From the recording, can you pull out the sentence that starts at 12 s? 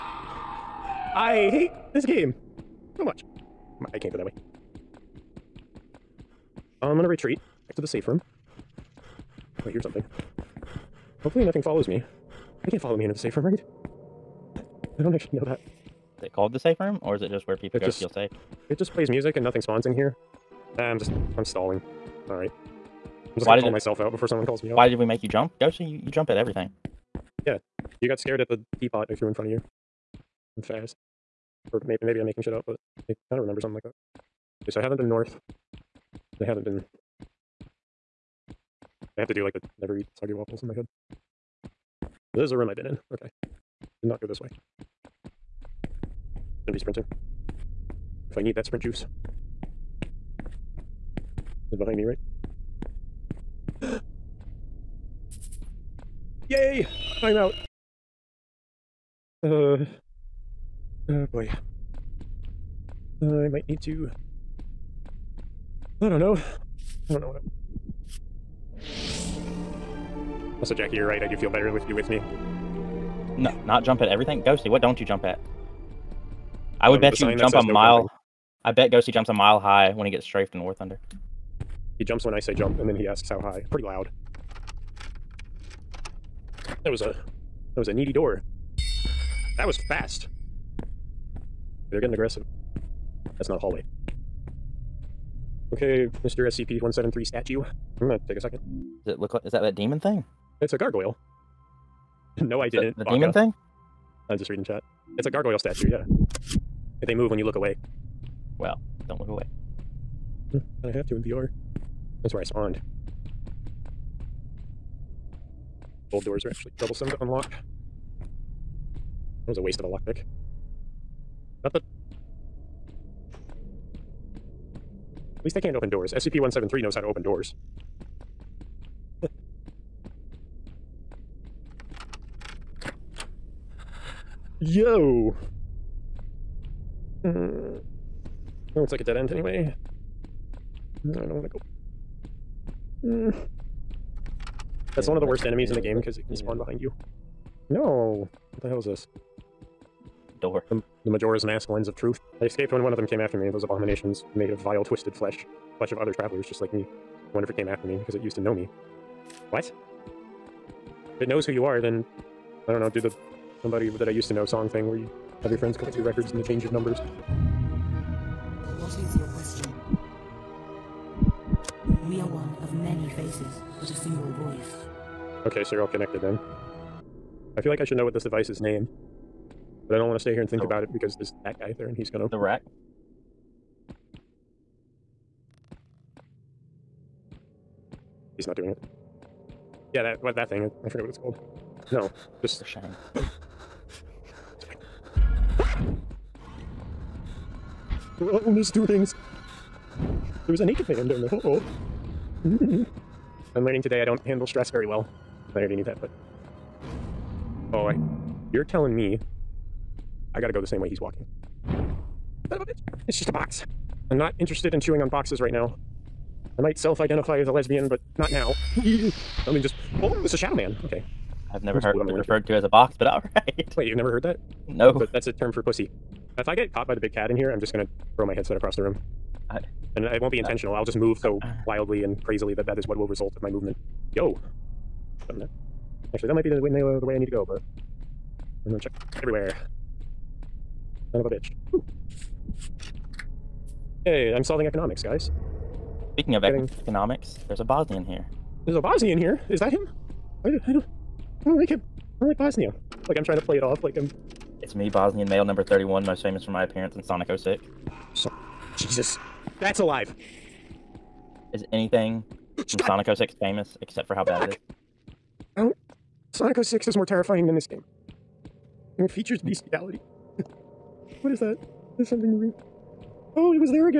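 They can't follow me into the safe room, right?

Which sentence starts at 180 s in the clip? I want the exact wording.
about it because there's that guy there and he's gonna.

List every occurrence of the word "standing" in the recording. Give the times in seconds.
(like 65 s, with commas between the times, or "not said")
not said.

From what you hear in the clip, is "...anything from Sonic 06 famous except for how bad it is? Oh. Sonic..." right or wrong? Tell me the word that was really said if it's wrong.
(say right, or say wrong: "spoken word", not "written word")
right.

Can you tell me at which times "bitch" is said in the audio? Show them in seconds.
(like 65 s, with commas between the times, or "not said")
212 s, 241 s.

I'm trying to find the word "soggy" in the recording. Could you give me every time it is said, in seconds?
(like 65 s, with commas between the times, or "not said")
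40 s.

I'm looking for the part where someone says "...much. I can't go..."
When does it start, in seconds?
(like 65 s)
3 s.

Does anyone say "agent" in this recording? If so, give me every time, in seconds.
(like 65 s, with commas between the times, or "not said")
not said.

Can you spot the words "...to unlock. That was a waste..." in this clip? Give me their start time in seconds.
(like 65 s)
117 s.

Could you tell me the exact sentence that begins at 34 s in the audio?
Okay, so I haven't been north.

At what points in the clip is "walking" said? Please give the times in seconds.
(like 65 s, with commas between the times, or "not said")
210 s.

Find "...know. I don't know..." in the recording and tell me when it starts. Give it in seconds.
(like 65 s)
66 s.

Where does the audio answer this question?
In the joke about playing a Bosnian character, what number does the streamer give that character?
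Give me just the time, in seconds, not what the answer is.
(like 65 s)
255 s.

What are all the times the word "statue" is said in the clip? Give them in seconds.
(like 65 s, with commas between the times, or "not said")
97 s, 105 s.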